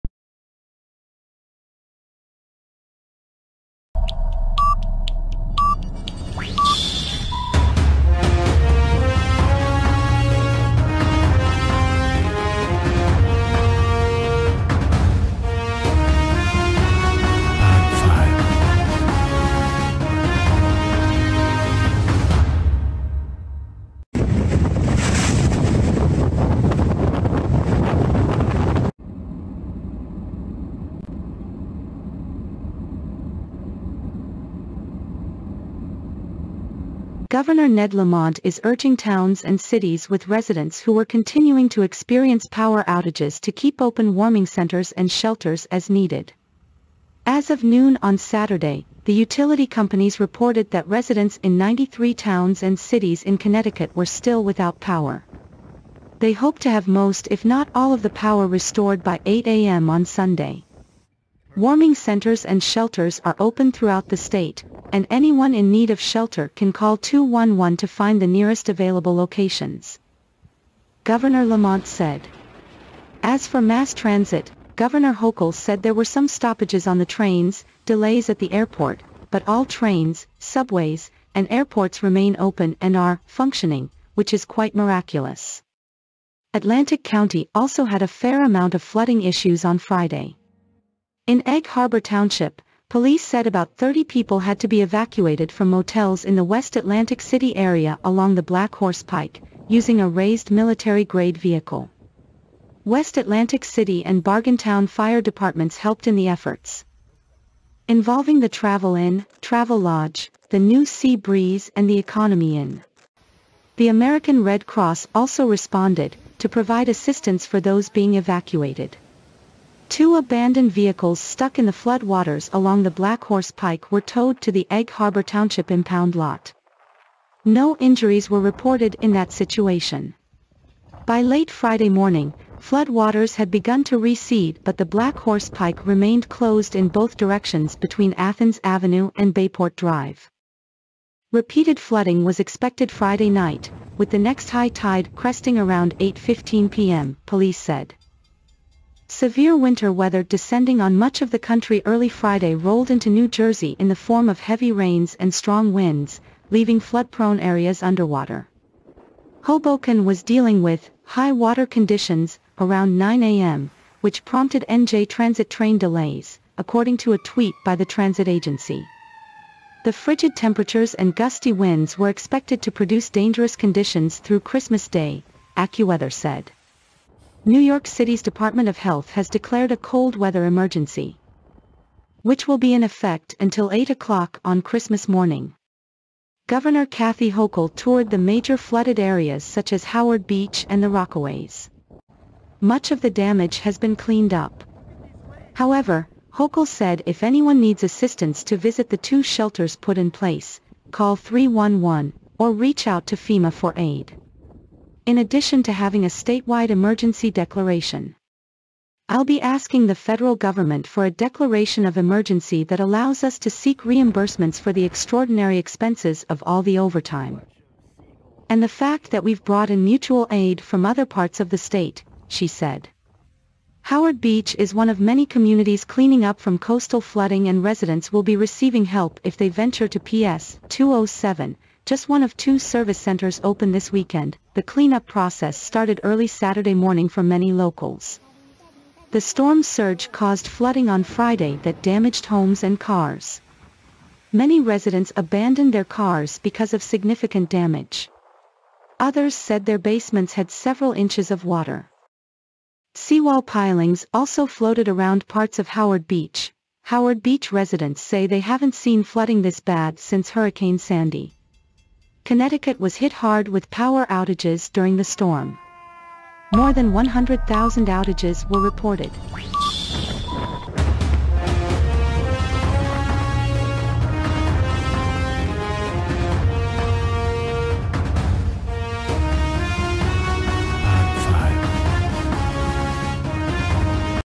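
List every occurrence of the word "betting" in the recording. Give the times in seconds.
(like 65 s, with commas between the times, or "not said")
not said.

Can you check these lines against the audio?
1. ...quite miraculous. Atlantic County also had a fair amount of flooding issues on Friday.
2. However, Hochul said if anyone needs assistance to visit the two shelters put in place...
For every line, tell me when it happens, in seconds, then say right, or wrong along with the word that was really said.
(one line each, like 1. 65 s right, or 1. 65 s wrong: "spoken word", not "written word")
1. 84 s right
2. 195 s right.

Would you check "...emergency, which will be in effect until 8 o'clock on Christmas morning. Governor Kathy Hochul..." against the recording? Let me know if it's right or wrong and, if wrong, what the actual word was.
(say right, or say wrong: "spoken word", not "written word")
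right.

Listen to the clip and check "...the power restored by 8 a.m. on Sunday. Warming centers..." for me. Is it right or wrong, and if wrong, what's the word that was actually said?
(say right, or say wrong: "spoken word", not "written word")
right.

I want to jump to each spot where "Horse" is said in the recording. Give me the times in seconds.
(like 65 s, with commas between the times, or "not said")
98 s, 123 s, 135 s.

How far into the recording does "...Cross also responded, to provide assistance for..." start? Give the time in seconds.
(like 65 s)
114 s.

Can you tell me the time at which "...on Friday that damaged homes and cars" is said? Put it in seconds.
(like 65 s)
240 s.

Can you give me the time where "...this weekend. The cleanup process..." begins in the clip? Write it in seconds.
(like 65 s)
233 s.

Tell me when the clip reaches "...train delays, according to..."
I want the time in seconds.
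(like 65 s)
165 s.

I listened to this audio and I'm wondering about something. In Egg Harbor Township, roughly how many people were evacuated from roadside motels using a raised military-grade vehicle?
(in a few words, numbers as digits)
30.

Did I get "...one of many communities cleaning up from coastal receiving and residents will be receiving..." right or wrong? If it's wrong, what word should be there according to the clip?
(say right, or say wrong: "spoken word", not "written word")
wrong: "flooding", not "receiving".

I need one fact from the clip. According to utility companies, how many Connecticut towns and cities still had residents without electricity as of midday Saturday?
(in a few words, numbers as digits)
93.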